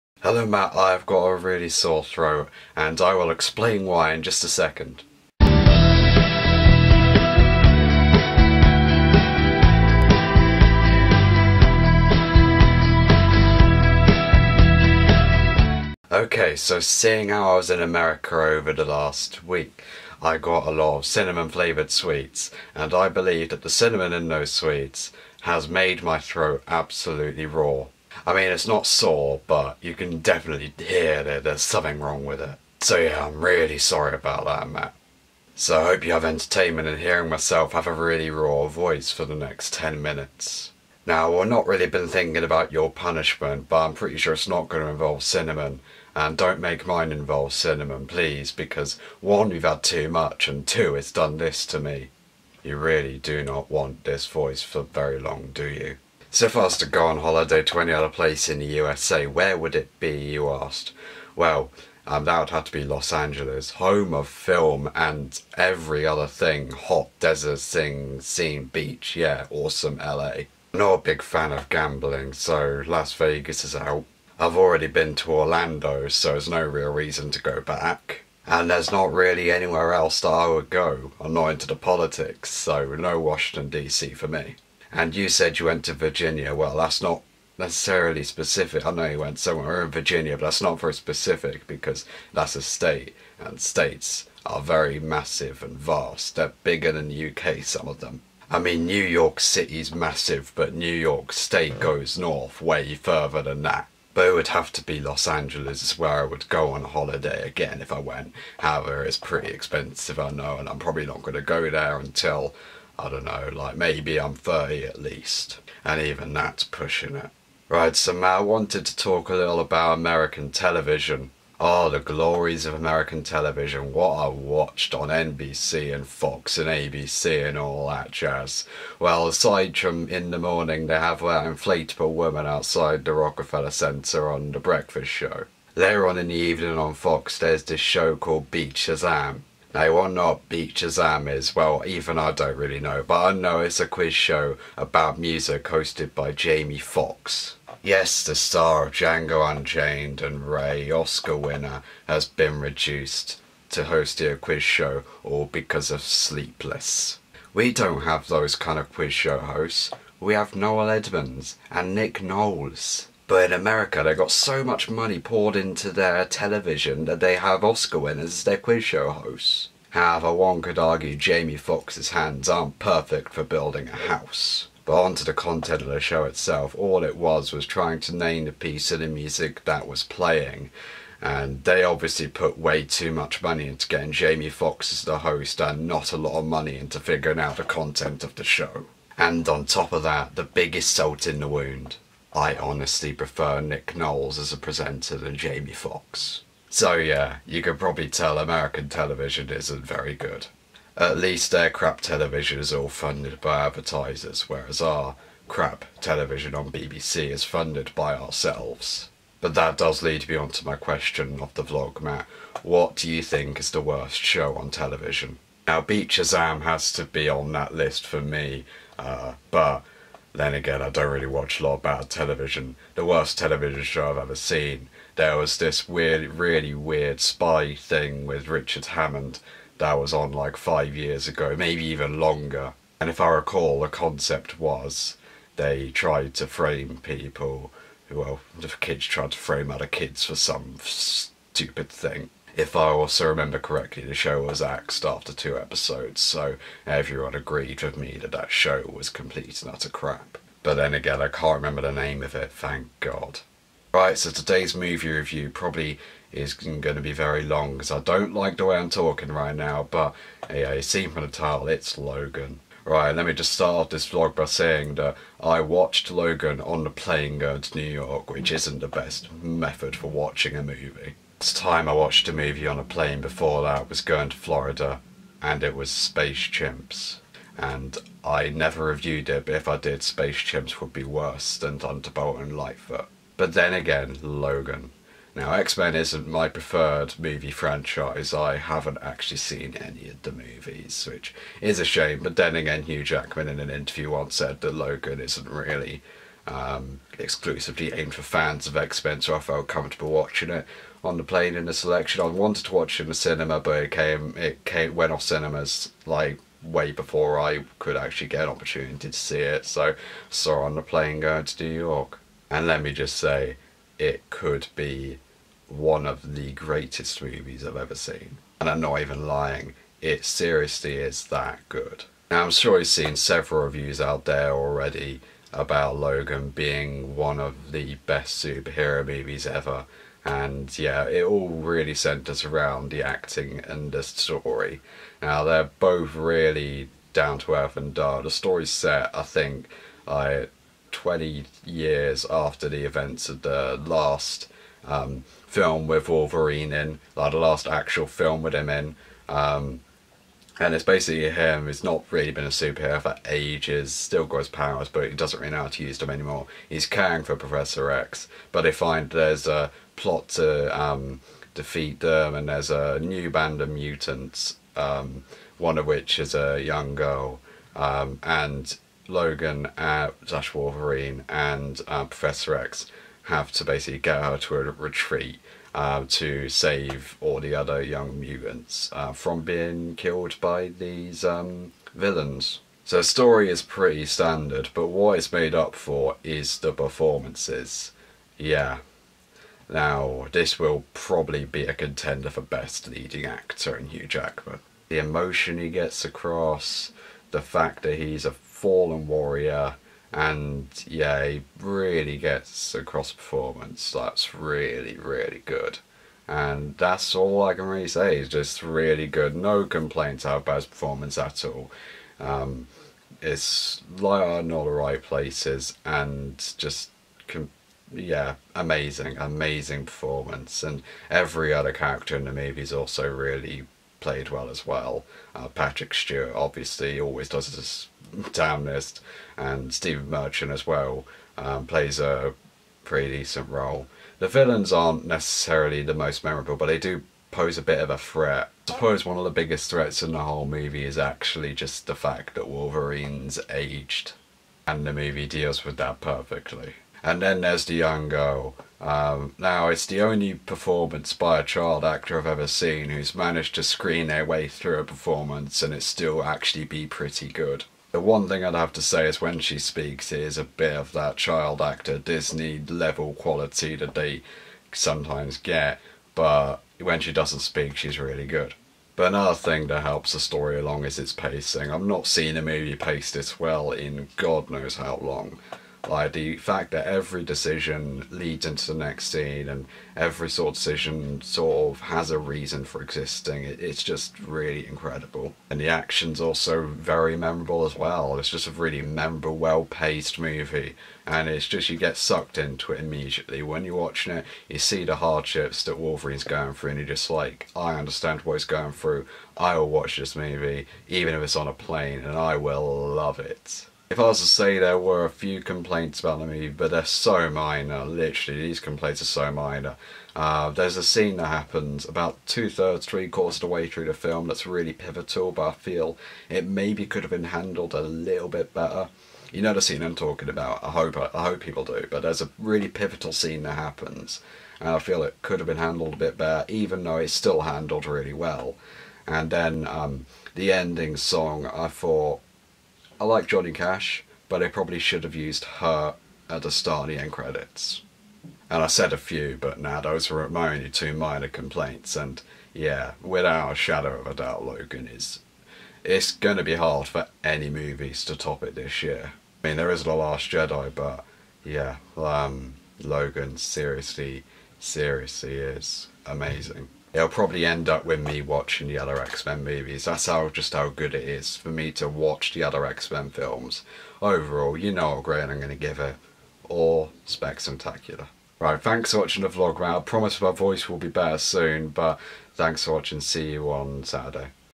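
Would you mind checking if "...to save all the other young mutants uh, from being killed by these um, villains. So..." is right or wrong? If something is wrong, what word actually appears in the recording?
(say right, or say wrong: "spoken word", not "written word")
right.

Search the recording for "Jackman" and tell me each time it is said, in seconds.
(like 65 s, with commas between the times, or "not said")
293 s, 394 s.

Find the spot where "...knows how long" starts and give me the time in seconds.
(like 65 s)
474 s.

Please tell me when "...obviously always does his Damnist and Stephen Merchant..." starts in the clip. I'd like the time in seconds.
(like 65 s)
426 s.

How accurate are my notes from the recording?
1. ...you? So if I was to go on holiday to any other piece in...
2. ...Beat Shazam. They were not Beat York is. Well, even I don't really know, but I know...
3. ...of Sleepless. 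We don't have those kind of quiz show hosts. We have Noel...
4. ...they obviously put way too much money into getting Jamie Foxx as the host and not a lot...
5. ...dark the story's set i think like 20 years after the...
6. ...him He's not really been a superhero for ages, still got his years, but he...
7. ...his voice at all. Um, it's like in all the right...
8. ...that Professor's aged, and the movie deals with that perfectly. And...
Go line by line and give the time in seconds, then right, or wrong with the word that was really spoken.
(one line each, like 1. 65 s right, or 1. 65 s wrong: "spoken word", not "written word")
1. 55 s wrong: "place", not "piece"
2. 138 s wrong: "Shazam", not "York"
3. 155 s right
4. 181 s right
5. 337 s right
6. 351 s wrong: "powers", not "years"
7. 410 s wrong: "performance", not "voice"
8. 442 s wrong: "Wolverine", not "Professor".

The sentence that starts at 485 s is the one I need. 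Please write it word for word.
And the action's also very memorable as well.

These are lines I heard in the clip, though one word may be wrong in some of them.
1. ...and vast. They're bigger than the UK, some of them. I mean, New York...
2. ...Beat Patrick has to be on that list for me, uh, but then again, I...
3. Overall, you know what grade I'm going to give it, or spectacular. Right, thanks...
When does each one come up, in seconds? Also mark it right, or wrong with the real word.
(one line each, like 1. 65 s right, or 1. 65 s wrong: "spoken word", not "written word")
1. 95 s right
2. 215 s wrong: "Shazam", not "Patrick"
3. 564 s right.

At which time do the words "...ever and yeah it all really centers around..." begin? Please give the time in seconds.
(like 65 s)
329 s.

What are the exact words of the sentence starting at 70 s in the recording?
not a big fan of gambling, so Las Vegas is out.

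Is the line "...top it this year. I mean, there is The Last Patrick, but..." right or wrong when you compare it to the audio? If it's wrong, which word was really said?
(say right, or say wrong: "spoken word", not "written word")
wrong: "Jedi", not "Patrick".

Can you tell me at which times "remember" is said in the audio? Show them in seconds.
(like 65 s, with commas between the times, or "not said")
243 s, 251 s.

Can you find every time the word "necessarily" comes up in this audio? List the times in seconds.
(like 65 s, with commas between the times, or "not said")
87 s, 435 s.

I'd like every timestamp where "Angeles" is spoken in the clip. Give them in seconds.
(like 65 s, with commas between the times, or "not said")
63 s, 105 s.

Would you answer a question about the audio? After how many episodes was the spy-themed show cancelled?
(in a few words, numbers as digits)
2.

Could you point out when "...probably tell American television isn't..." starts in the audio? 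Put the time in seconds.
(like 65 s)
197 s.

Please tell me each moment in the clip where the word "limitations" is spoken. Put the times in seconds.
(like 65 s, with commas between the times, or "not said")
not said.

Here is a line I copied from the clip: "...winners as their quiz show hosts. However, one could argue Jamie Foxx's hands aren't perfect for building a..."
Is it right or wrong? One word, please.
right.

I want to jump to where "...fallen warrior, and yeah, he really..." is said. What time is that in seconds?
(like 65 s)
398 s.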